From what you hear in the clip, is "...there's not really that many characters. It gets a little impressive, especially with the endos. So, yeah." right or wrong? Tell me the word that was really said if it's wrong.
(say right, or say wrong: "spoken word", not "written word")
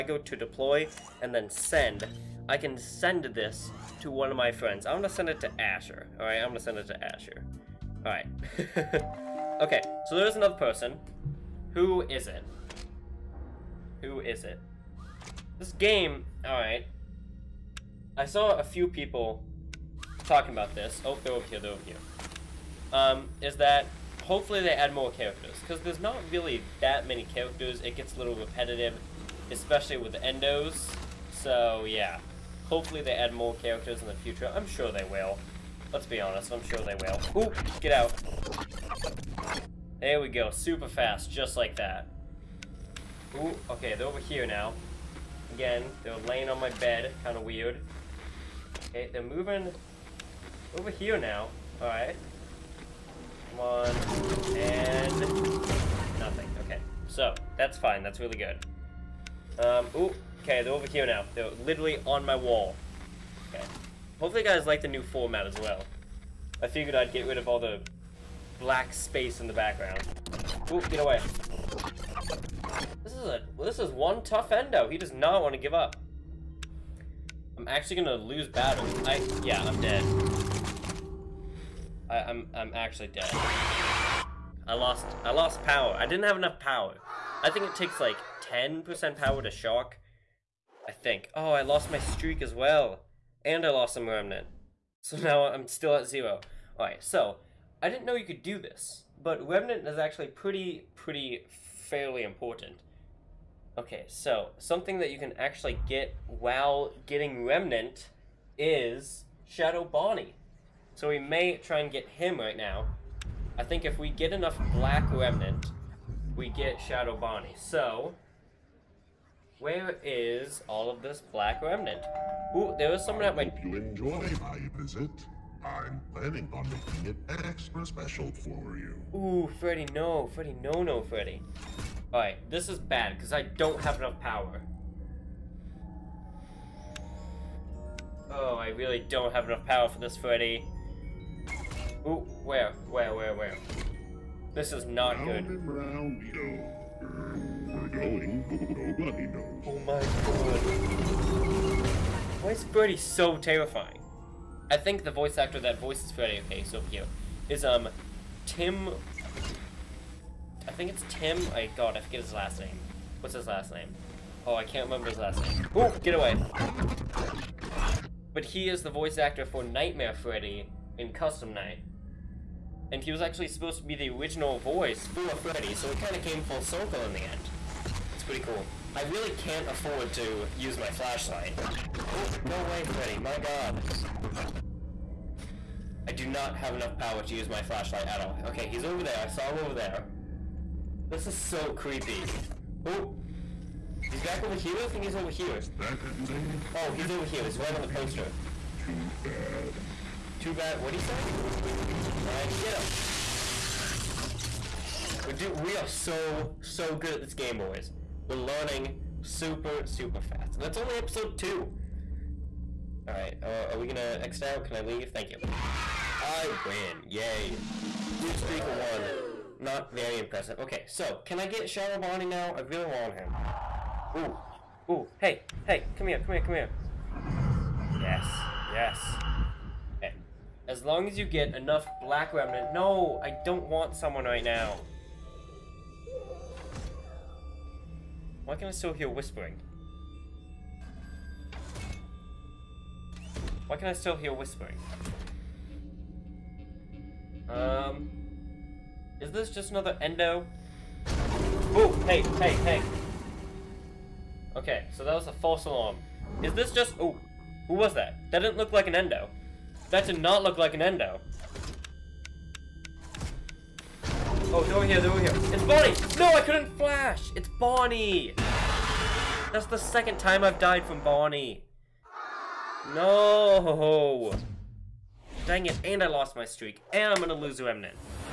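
wrong: "repetitive", not "impressive".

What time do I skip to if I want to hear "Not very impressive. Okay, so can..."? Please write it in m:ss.
3:39.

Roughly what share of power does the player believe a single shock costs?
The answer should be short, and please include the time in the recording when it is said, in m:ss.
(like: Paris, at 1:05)
10%, at 1:28.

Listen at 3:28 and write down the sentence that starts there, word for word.
We're learning super super fast, and that's only episode two.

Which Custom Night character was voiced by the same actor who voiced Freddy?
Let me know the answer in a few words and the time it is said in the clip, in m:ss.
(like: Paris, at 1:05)
Nightmare Freddy, at 2:49.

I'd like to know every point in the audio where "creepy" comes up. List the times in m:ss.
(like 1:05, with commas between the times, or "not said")
3:11.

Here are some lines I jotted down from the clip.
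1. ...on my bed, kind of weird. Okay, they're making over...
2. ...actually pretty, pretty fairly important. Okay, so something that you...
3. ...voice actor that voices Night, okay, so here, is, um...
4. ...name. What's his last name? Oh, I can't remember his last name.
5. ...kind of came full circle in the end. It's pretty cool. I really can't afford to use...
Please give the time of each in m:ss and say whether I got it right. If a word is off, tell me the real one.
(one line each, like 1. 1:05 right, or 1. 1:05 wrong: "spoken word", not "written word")
1. 0:46 wrong: "moving", not "making"
2. 1:39 right
3. 2:35 wrong: "Freddy", not "Night"
4. 2:42 right
5. 2:55 right.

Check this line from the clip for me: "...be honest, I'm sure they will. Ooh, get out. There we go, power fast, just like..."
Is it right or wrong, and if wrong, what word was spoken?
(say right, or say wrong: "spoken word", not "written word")
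wrong: "super", not "power".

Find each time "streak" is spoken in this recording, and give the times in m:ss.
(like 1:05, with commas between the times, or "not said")
1:31, 3:38, 4:36.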